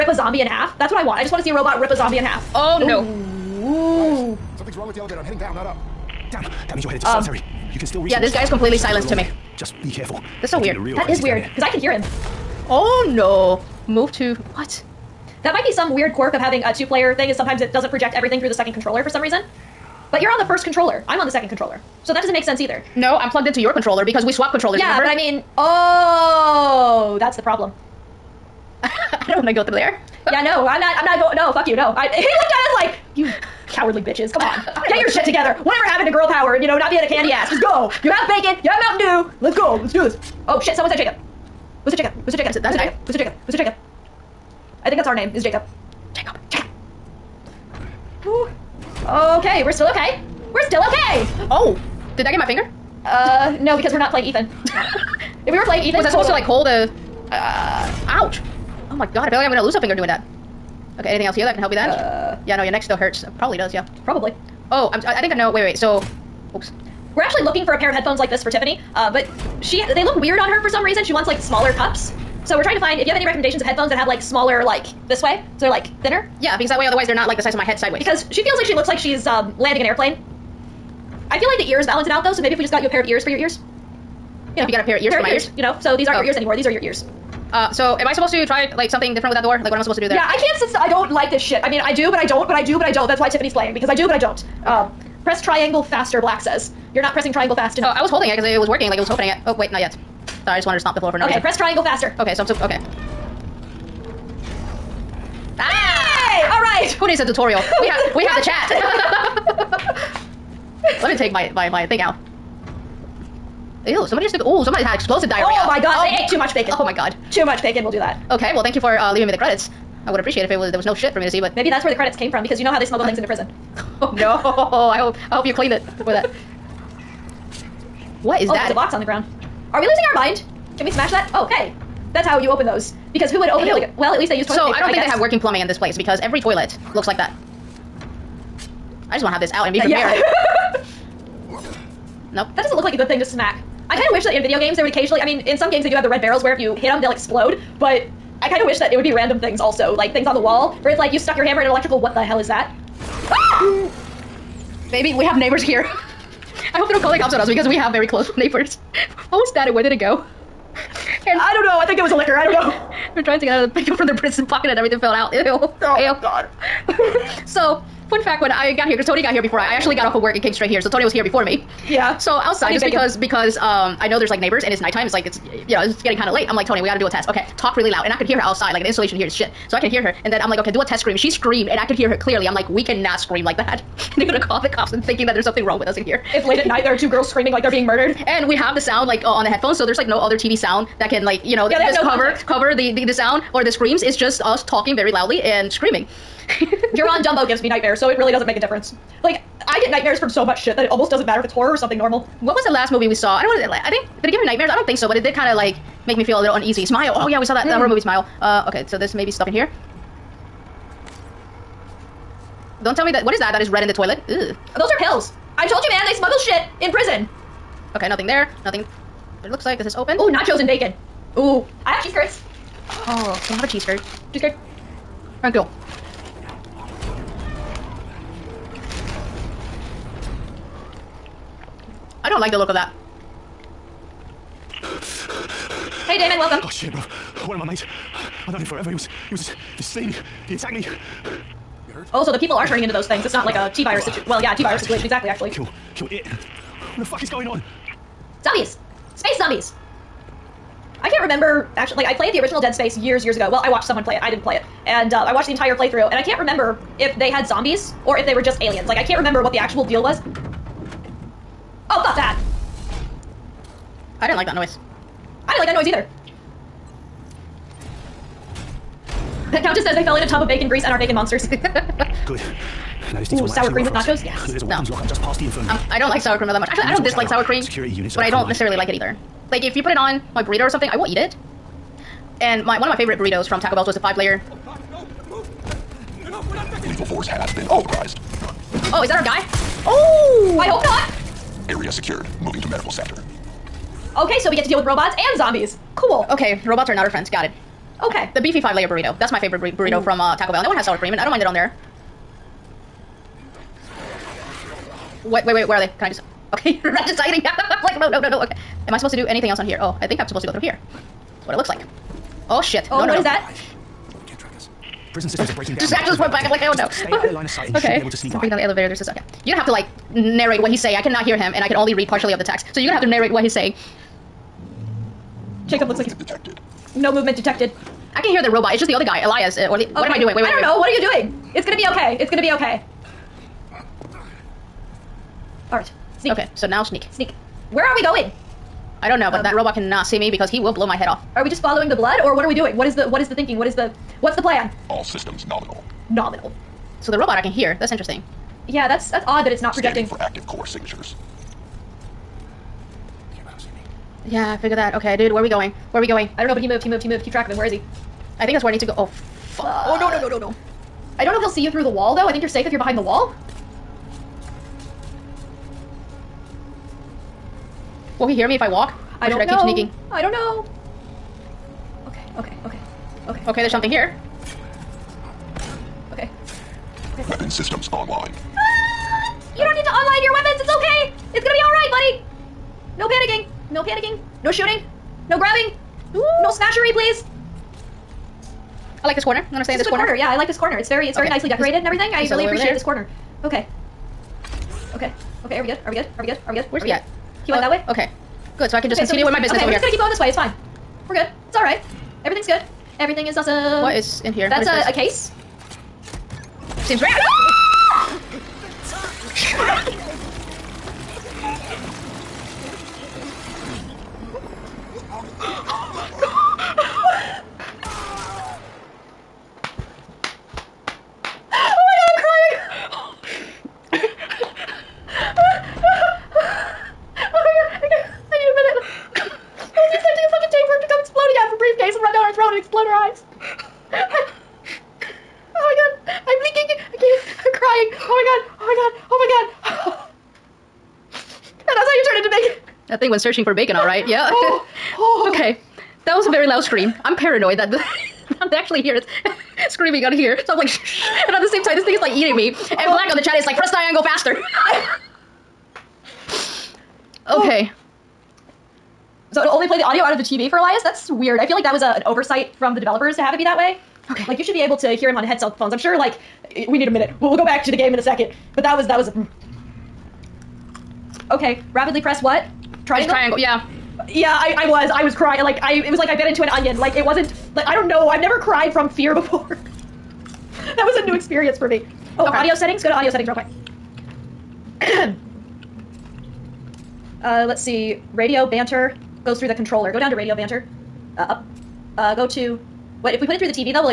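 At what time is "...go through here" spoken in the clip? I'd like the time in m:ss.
5:10.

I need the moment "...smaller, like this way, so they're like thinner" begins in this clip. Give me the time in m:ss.
1:14.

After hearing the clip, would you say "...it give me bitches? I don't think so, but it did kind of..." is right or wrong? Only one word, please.
wrong.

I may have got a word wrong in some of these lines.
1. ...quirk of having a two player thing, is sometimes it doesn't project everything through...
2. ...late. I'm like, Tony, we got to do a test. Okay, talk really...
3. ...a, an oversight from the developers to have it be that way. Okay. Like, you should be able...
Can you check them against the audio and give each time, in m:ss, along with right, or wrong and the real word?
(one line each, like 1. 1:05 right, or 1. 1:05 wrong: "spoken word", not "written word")
1. 0:16 right
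2. 2:56 right
3. 7:41 right.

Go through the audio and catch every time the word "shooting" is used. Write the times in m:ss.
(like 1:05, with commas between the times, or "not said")
6:24.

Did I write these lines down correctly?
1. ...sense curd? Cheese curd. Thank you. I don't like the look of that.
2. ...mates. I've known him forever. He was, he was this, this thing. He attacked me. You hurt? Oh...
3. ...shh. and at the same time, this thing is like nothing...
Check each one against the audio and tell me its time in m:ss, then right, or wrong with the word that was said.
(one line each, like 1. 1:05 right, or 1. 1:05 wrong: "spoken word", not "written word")
1. 3:43 wrong: "cheese", not "sense"
2. 3:57 right
3. 7:30 wrong: "eating", not "nothing".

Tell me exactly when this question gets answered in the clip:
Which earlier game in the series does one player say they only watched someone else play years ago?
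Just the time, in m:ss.
4:12.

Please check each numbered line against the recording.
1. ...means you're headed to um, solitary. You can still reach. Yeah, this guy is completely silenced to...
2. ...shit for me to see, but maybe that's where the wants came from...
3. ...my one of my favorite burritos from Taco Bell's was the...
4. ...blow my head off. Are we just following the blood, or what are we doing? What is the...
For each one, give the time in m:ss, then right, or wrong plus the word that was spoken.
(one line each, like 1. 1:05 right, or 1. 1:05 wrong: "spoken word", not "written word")
1. 0:06 right
2. 2:00 wrong: "credits", not "wants"
3. 4:42 right
4. 5:40 right.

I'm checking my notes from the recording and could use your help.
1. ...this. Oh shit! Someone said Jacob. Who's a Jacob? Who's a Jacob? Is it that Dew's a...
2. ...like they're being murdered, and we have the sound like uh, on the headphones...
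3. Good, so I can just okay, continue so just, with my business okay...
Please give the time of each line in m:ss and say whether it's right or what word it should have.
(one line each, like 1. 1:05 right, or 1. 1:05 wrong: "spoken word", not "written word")
1. 0:40 wrong: "Who", not "Dew"
2. 3:07 right
3. 6:38 right.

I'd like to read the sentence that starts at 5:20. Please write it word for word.
I cannot hear him, and I can only read partially of the text.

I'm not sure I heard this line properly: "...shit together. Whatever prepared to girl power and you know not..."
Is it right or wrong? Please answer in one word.
wrong.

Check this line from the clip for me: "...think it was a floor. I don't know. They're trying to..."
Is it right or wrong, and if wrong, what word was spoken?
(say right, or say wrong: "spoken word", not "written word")
wrong: "liquor", not "floor".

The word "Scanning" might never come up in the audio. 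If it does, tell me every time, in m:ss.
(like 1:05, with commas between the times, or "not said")
5:50.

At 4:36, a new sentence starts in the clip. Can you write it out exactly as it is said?
Actually, we I don't dislike sour cream.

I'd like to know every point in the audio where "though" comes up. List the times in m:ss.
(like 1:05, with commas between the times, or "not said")
1:22, 6:02.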